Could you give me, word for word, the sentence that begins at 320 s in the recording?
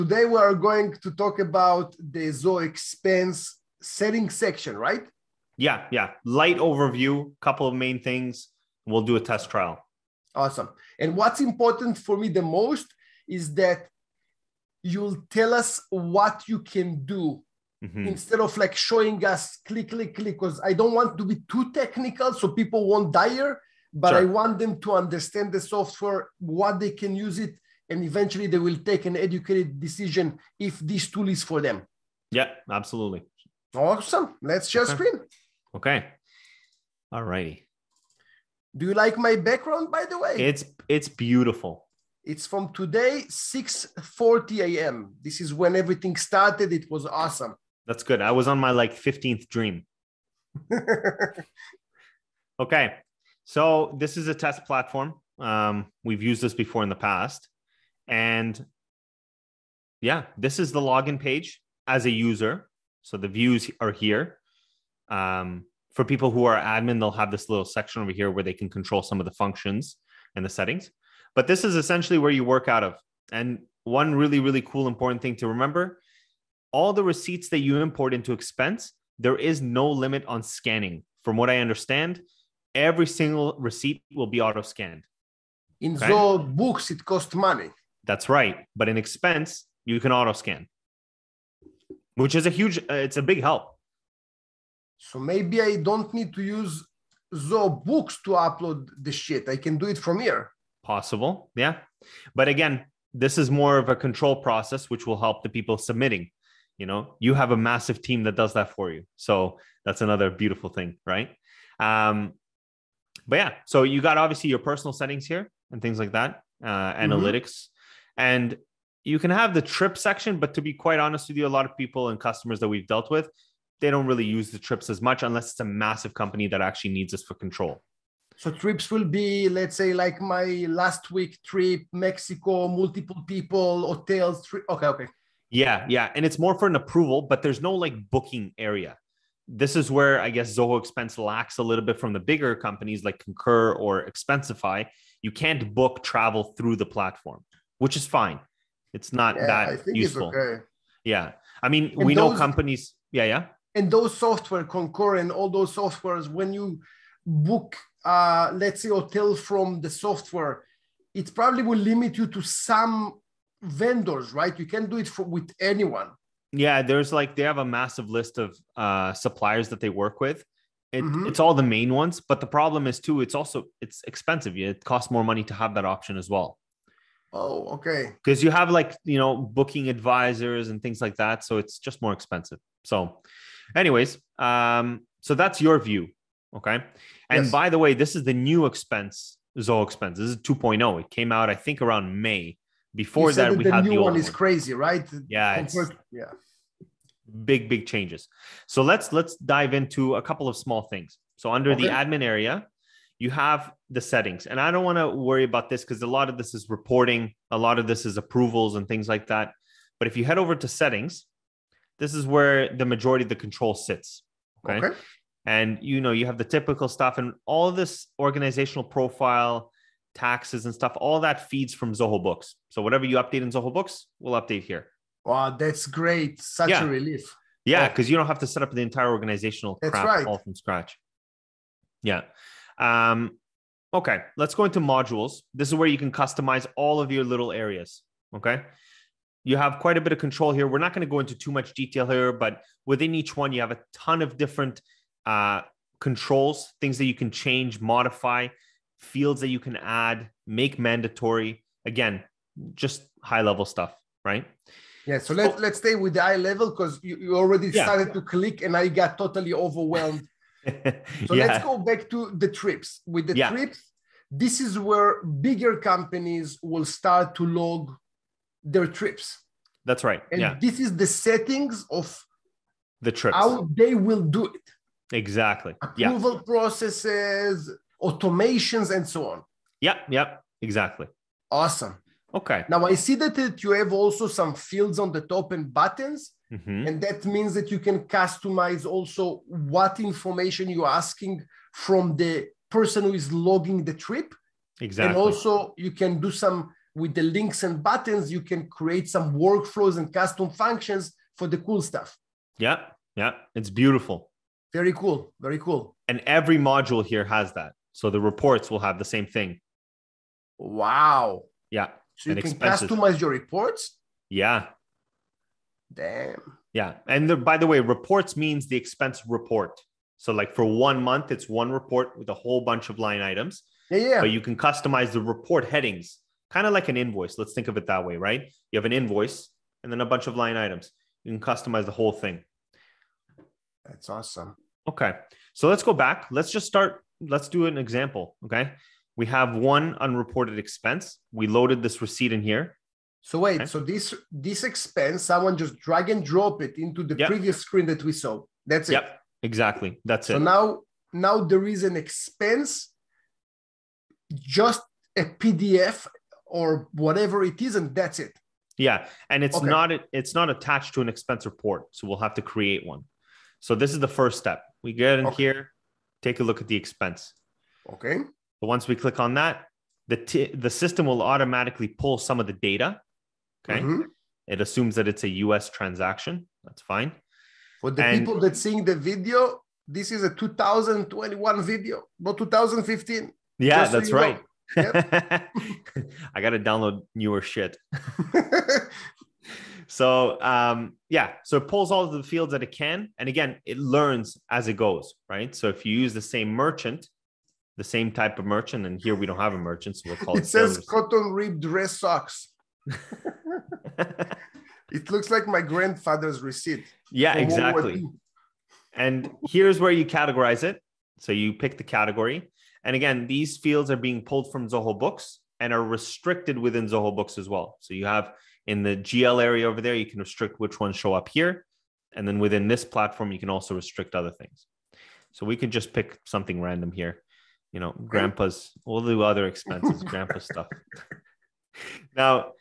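So like for one month, it's one report with a whole bunch of line items.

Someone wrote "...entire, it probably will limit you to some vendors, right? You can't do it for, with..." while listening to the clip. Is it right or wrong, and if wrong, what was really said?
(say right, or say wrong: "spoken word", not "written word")
wrong: "software", not "entire".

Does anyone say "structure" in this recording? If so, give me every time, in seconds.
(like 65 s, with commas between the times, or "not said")
not said.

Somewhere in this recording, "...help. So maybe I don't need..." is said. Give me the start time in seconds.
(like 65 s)
93 s.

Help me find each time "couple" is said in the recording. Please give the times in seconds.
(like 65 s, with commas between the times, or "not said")
7 s, 200 s.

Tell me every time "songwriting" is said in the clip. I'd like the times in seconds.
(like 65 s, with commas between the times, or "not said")
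not said.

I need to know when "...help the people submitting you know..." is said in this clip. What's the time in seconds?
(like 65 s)
105 s.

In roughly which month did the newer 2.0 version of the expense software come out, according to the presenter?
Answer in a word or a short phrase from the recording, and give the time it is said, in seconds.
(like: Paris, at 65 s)
May, at 192 s.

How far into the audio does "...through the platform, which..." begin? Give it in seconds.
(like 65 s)
146 s.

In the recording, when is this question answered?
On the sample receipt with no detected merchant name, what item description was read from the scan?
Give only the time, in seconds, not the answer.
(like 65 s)
400 s.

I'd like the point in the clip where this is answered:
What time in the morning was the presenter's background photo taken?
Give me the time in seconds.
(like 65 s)
43 s.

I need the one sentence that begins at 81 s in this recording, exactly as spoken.
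From what I understand, every single receipt will be auto scanned.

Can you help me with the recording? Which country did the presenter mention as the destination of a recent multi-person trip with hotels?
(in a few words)
Mexico.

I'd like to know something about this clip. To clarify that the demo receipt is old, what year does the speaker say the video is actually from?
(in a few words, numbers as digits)
2021.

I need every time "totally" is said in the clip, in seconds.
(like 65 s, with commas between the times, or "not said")
259 s.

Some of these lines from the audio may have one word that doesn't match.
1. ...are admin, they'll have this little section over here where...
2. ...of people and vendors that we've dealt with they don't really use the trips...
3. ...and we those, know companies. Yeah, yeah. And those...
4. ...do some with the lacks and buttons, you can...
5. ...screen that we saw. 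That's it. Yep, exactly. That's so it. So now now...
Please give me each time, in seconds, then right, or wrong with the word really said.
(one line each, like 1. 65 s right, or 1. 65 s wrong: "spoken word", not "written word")
1. 66 s right
2. 121 s wrong: "customers", not "vendors"
3. 151 s right
4. 296 s wrong: "links", not "lacks"
5. 347 s right.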